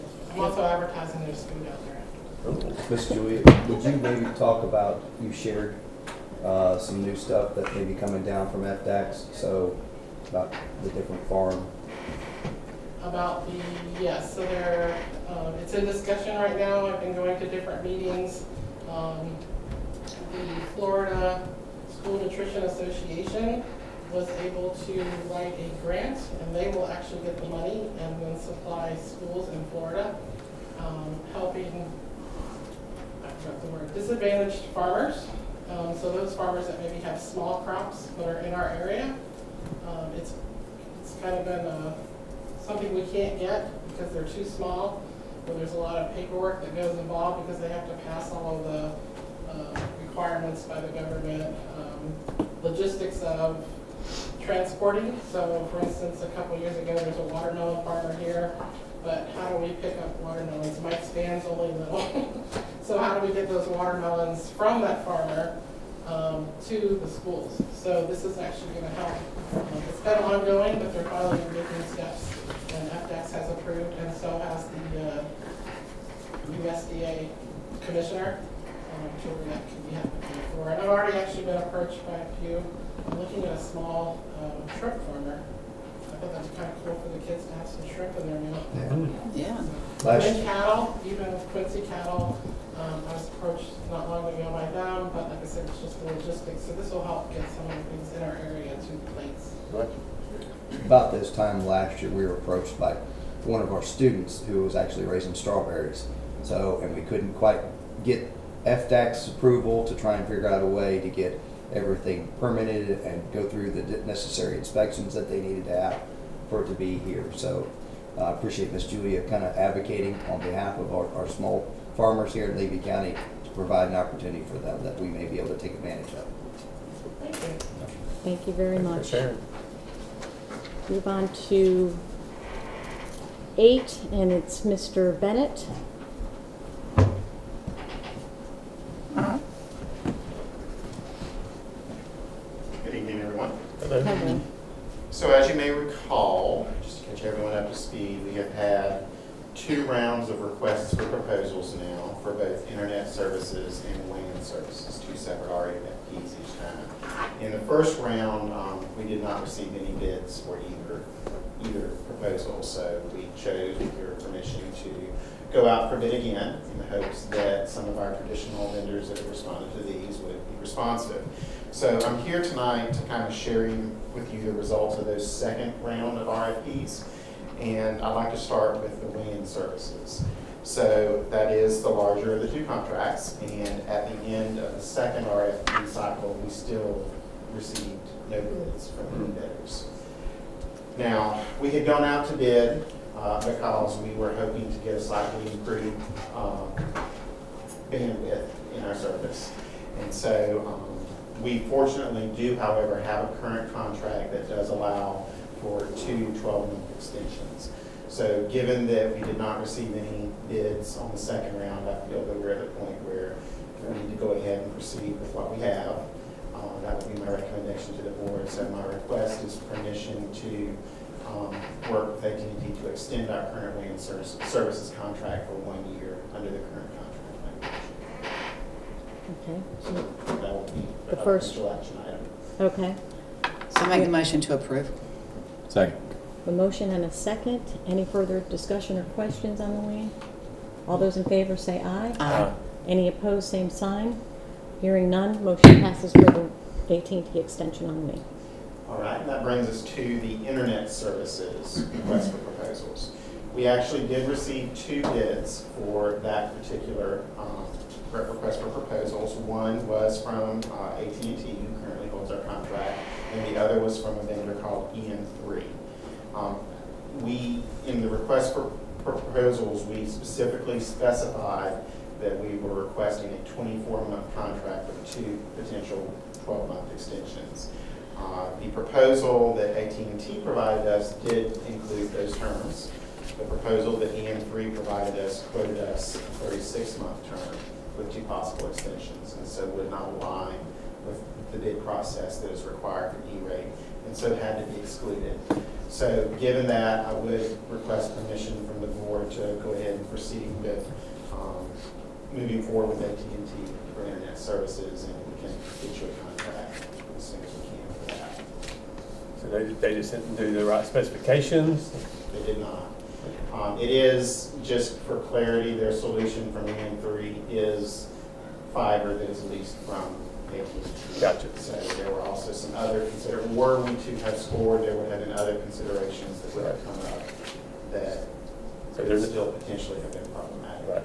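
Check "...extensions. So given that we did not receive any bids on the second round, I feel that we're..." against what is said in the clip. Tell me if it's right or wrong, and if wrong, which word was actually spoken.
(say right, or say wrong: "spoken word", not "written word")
right.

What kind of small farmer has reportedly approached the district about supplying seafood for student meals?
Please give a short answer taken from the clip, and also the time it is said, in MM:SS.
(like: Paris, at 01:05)
shrimp farmer, at 01:24.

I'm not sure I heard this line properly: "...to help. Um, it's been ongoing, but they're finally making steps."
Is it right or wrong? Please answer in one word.
right.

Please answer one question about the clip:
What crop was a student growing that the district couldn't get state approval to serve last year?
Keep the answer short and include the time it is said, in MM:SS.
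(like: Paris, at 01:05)
strawberries, at 01:45.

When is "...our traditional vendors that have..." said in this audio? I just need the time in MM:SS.
02:47.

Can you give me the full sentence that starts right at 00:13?
About the, yes, so there, uh, um, it's in discussion right now.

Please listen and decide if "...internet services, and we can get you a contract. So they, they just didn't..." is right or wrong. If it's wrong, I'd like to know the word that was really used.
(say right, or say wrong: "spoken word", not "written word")
right.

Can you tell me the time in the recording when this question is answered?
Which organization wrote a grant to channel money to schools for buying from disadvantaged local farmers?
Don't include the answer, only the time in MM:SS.
00:20.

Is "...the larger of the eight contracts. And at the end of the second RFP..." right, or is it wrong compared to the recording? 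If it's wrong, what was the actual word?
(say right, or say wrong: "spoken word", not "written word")
wrong: "two", not "eight".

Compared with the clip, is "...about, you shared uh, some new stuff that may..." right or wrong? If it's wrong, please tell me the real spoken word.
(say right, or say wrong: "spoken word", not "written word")
right.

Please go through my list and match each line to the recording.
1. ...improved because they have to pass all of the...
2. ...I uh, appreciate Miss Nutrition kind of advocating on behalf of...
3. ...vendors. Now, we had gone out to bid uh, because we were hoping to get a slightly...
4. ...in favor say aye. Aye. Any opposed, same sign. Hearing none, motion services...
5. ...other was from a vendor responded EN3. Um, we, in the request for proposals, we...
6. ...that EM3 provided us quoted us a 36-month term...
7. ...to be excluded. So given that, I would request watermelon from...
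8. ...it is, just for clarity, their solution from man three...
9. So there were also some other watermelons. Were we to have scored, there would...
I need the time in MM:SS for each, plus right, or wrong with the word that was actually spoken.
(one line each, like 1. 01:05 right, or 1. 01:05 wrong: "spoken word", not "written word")
1. 00:46 wrong: "involved", not "improved"
2. 01:58 wrong: "Julia", not "Nutrition"
3. 03:09 wrong: "bidders", not "vendors"
4. 04:01 wrong: "passes", not "services"
5. 04:23 wrong: "called", not "responded"
6. 04:43 right
7. 04:54 wrong: "permission", not "watermelon"
8. 05:13 right
9. 05:21 wrong: "considerations", not "watermelons".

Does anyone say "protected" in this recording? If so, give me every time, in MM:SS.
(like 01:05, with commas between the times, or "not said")
not said.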